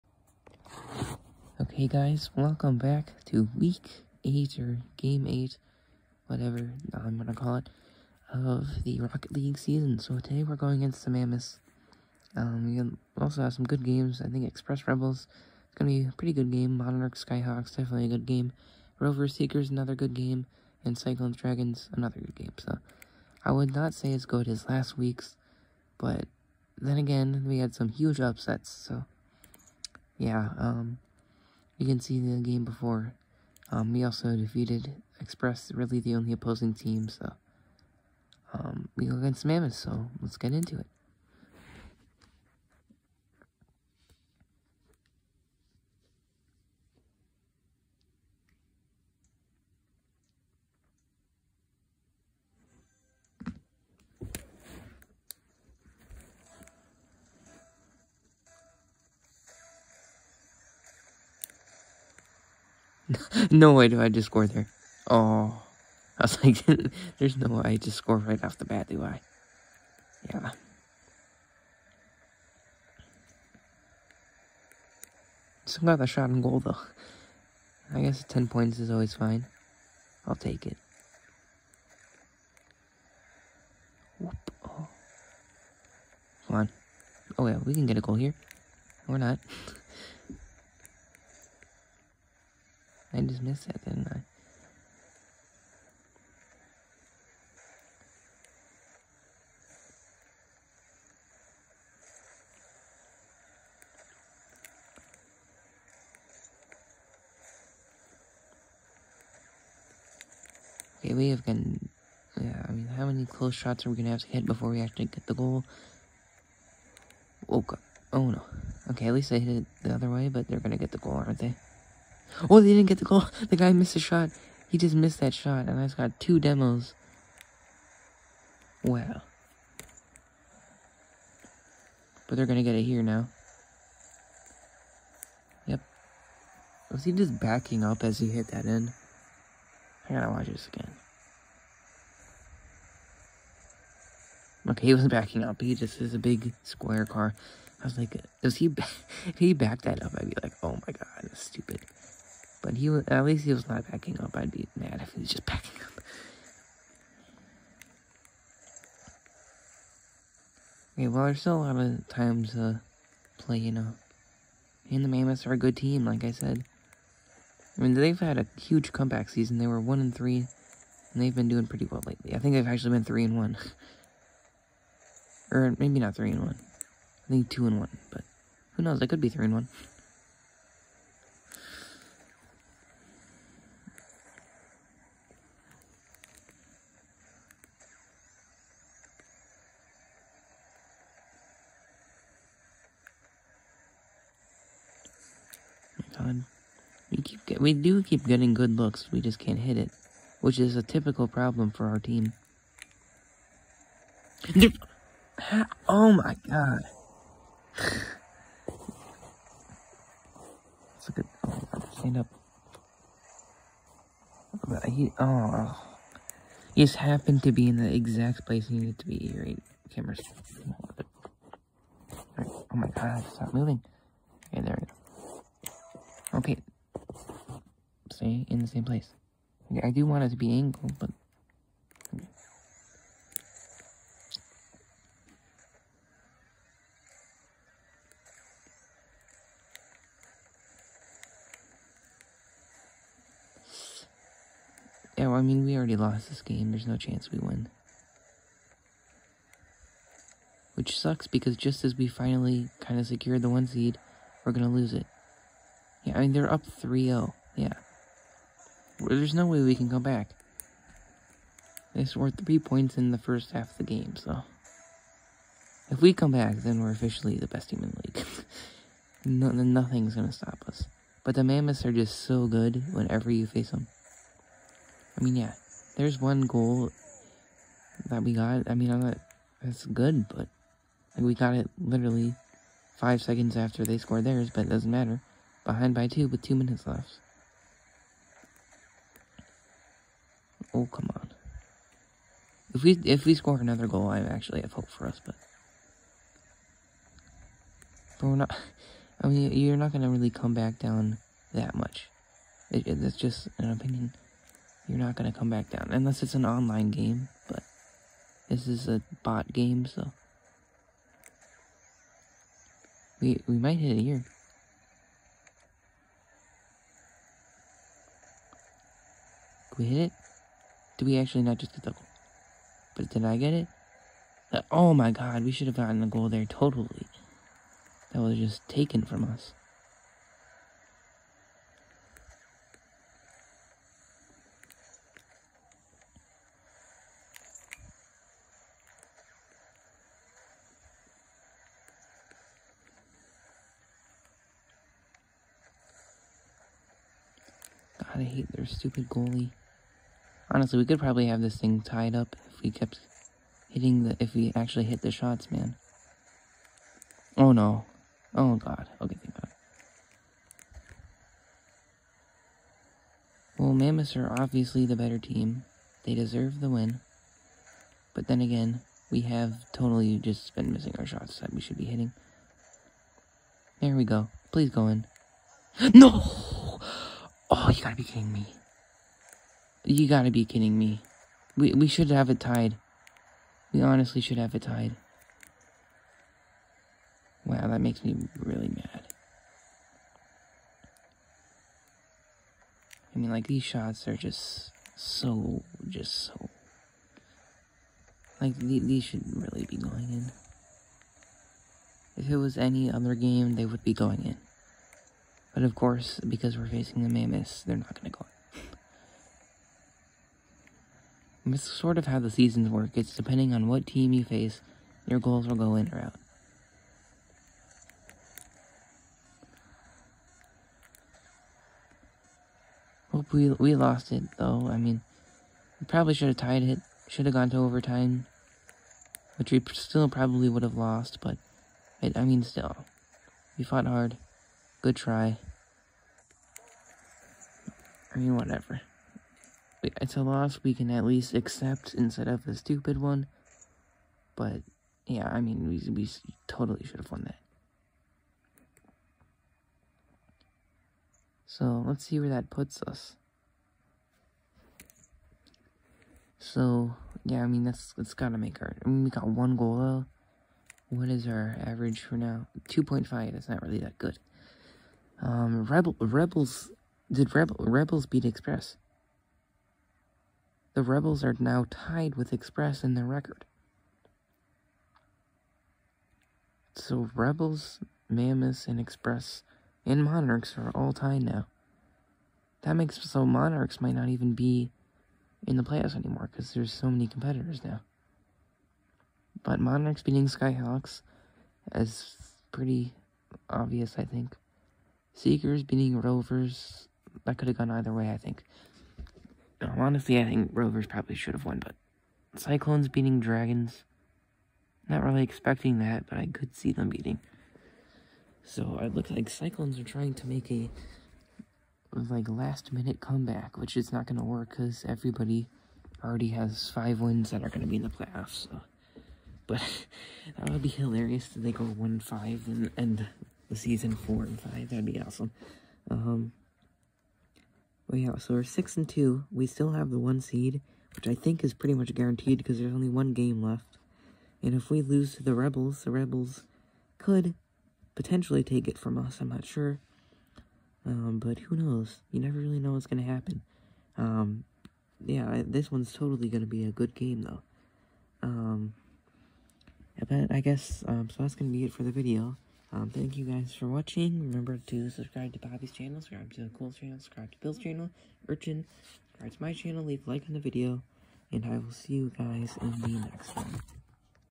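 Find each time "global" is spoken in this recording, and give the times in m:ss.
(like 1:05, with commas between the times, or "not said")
not said.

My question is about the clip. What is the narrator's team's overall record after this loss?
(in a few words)
6 and 2.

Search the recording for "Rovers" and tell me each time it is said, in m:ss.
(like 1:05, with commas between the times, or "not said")
0:18, 8:15, 8:20.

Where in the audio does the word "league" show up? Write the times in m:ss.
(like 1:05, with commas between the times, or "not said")
0:09, 4:28.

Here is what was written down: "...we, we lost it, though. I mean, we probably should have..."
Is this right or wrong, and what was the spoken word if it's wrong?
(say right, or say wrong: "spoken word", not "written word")
right.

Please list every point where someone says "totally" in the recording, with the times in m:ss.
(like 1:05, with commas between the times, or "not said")
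5:26, 6:09, 7:26, 9:05.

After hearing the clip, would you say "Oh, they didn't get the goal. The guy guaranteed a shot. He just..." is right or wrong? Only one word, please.
wrong.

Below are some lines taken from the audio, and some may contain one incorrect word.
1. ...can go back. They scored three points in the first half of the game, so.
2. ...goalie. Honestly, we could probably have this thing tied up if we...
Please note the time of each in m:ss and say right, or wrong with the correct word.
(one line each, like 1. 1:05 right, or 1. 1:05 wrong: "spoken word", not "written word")
1. 4:19 right
2. 5:49 right.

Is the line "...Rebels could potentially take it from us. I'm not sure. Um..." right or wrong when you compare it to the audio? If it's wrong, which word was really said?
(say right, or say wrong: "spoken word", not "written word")
right.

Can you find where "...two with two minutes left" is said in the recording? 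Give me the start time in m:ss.
4:46.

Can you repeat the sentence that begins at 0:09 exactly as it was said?
So today we're going against the Mammoths.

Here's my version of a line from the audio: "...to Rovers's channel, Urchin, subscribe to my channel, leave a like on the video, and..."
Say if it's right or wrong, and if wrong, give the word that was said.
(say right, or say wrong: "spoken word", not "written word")
wrong: "Bill", not "Rovers".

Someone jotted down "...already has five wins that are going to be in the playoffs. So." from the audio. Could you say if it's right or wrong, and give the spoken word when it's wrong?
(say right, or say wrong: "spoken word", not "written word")
right.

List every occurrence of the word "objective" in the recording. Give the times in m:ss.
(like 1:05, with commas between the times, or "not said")
not said.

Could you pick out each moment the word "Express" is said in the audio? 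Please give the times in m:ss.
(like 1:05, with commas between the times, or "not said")
0:14, 0:35, 7:48, 7:52, 7:58.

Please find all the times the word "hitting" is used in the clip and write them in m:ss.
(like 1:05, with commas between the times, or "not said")
5:53, 6:11.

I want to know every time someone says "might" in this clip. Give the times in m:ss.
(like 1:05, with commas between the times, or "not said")
5:13, 8:03.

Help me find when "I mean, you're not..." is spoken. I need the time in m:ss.
4:59.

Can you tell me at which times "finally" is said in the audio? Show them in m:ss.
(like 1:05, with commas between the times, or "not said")
4:12.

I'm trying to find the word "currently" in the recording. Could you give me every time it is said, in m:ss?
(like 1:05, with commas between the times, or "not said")
not said.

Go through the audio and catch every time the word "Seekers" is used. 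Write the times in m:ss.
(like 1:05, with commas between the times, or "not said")
0:19, 8:15.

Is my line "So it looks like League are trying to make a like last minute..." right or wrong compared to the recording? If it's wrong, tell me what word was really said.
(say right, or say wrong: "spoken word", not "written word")
wrong: "Cyclones", not "League".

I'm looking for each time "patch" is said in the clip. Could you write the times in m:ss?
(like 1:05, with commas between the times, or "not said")
not said.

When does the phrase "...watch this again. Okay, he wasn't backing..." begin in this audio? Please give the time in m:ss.
2:20.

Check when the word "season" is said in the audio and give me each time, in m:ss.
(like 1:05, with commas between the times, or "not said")
0:09, 2:49, 6:52, 8:43.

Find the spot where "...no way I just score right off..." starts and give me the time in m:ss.
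1:07.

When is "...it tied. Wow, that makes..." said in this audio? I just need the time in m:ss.
6:24.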